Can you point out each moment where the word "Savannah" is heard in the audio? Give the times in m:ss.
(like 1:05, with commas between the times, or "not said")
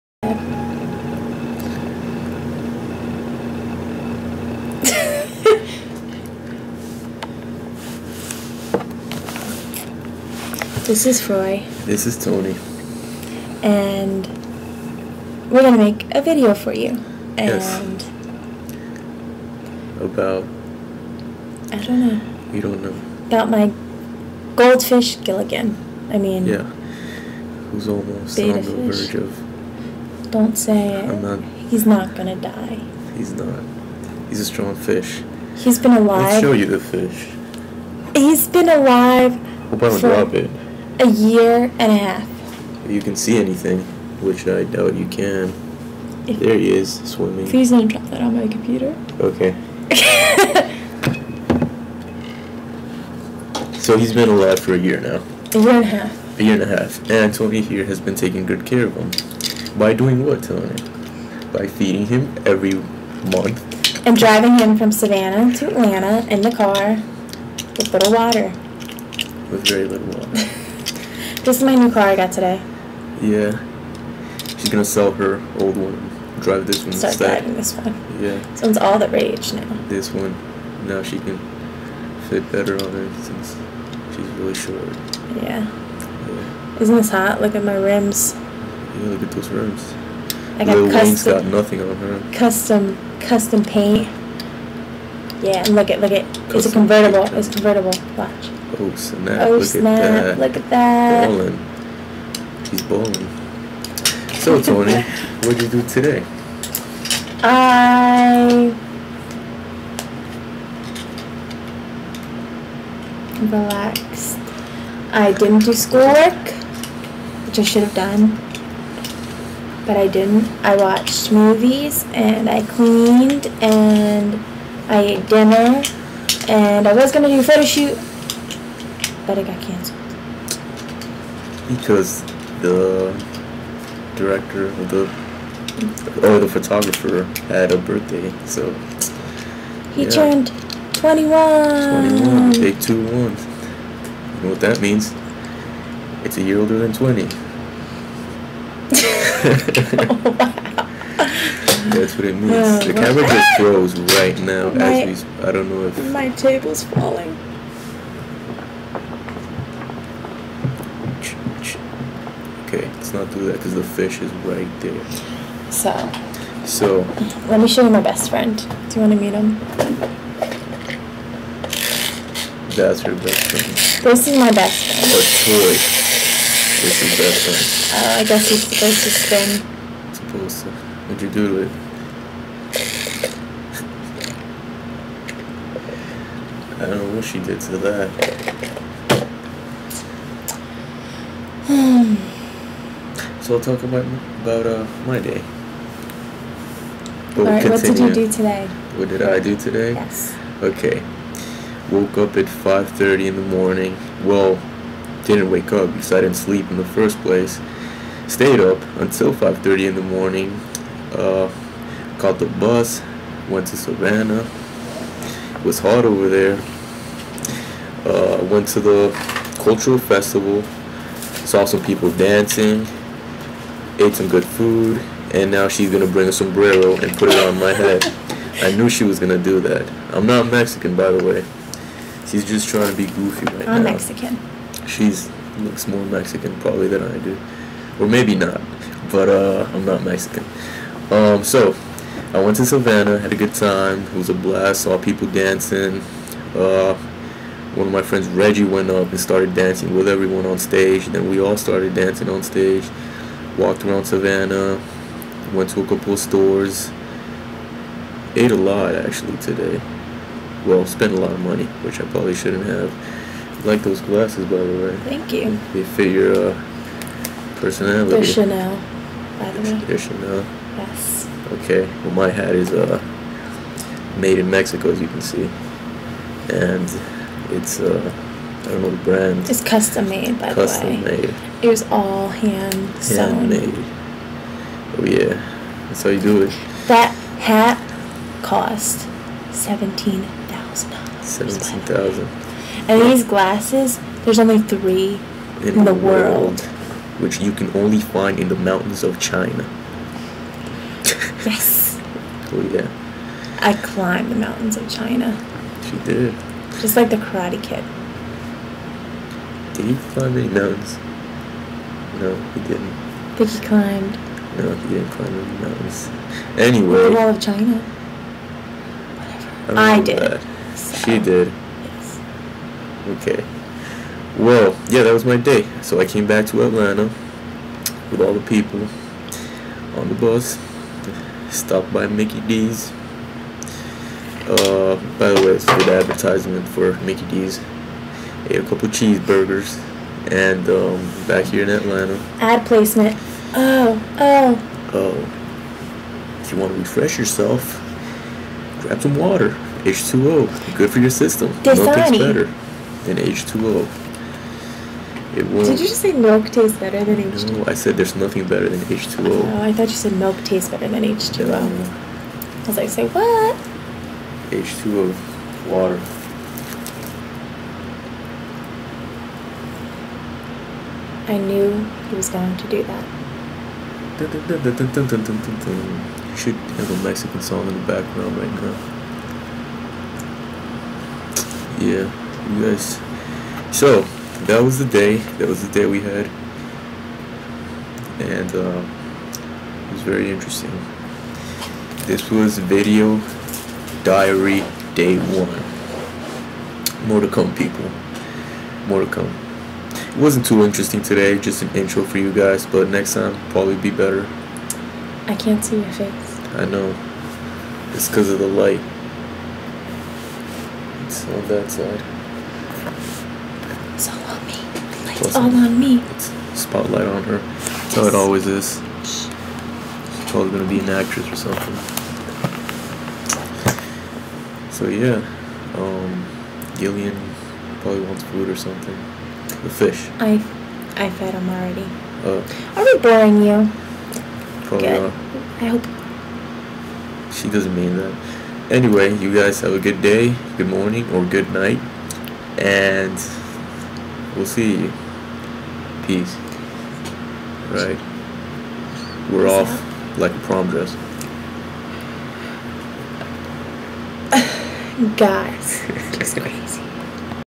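1:04, 3:33, 4:02, 4:14.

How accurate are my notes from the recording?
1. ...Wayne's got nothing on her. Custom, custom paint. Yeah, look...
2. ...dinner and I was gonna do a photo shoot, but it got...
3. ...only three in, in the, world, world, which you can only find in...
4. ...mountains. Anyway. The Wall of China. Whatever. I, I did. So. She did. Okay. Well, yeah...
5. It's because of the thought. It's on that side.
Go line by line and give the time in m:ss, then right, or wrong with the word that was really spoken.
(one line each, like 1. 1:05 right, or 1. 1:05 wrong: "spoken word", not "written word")
1. 1:31 right
2. 2:05 right
3. 4:54 right
4. 5:15 right
5. 6:47 wrong: "light", not "thought".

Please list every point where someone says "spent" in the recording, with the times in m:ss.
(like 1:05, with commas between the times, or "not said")
4:20.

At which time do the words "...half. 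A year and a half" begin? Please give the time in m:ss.
0:55.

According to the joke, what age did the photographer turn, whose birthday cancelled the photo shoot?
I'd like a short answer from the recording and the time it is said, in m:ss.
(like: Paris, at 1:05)
21, at 2:20.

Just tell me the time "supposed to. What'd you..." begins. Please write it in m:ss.
3:00.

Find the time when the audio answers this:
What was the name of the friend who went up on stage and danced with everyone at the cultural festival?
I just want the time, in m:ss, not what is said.
4:08.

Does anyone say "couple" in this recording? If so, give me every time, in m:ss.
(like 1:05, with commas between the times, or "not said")
4:15, 5:38.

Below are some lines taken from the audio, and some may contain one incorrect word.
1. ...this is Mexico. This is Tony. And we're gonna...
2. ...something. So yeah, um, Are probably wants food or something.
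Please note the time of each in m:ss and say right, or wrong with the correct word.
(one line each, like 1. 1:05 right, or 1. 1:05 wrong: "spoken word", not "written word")
1. 0:10 wrong: "Roy", not "Mexico"
2. 7:01 wrong: "Gillian", not "Are".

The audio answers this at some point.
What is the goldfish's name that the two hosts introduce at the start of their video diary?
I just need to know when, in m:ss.
0:25.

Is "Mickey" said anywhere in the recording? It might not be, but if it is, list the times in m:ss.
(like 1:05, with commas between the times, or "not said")
5:32, 5:37.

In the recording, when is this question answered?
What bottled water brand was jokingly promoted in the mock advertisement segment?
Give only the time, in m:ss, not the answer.
5:51.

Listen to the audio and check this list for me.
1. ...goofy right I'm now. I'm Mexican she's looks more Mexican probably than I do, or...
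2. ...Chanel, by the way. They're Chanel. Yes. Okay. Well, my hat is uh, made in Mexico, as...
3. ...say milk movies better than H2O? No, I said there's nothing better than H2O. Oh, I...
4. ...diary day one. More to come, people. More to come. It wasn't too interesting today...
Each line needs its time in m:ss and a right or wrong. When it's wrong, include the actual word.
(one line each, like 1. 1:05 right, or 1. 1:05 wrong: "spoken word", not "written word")
1. 3:53 right
2. 4:28 right
3. 5:56 wrong: "tastes", not "movies"
4. 6:34 right.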